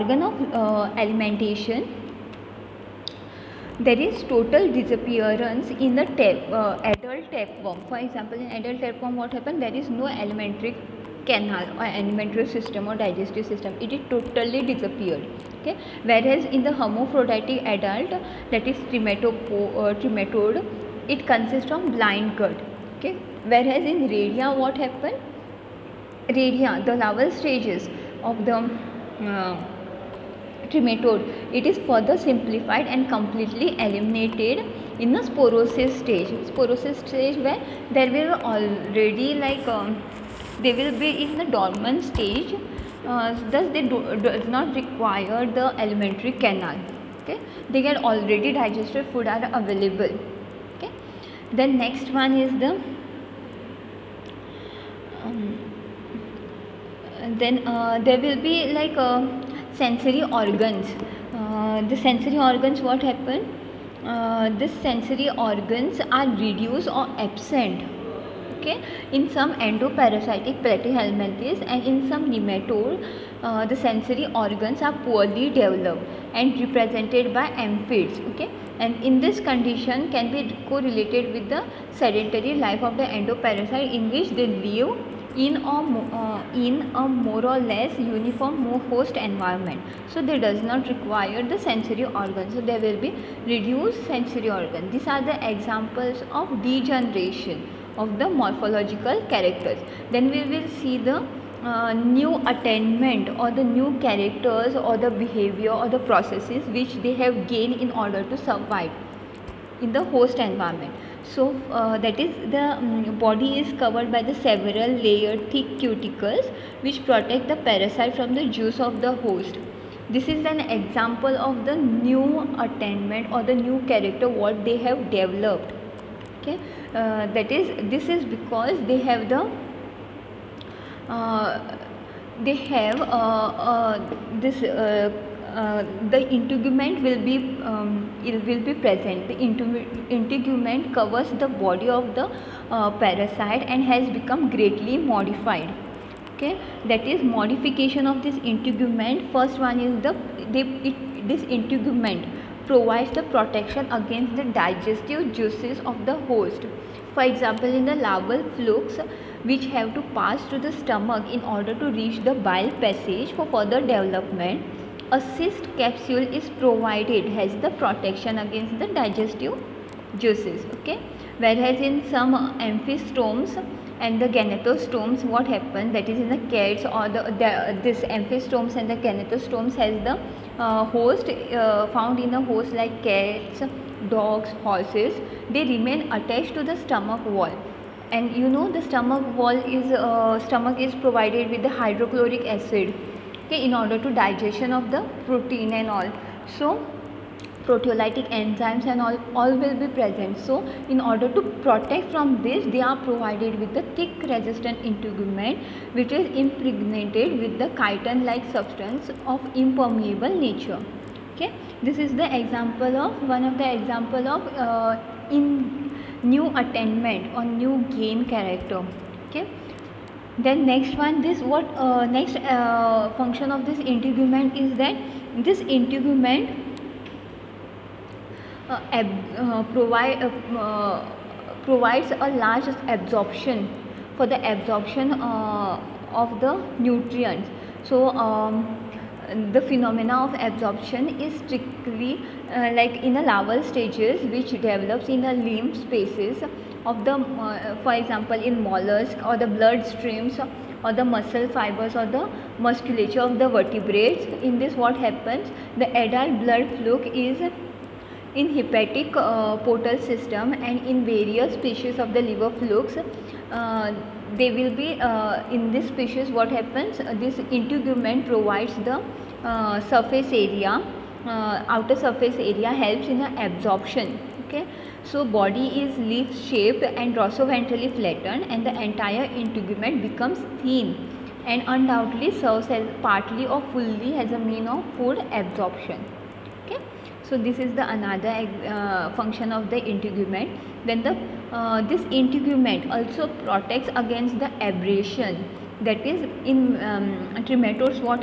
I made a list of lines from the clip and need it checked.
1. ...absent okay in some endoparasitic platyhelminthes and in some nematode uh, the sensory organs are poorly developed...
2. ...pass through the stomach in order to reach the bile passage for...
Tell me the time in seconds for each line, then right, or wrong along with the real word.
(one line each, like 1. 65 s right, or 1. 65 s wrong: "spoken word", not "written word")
1. 67 s right
2. 160 s right.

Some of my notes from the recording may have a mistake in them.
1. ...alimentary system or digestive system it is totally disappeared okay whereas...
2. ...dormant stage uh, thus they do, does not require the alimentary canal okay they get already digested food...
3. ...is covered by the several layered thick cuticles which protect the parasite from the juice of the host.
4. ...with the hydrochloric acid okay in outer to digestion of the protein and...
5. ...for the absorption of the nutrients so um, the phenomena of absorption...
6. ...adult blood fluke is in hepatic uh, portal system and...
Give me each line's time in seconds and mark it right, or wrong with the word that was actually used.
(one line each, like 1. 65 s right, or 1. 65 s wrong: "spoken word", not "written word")
1. 11 s right
2. 41 s right
3. 113 s right
4. 191 s wrong: "order", not "outer"
5. 234 s right
6. 256 s right.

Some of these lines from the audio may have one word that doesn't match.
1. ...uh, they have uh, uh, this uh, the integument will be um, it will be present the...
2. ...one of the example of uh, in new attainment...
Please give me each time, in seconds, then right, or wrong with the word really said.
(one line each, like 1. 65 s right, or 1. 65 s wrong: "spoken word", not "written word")
1. 131 s right
2. 213 s right.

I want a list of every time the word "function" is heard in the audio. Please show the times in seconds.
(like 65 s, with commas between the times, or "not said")
223 s, 289 s.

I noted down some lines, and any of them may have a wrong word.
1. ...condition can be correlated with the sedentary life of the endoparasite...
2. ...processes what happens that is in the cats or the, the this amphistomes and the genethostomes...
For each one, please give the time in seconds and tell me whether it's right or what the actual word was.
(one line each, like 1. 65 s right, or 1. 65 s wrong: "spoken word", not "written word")
1. 79 s right
2. 174 s wrong: "genethostomes", not "processes".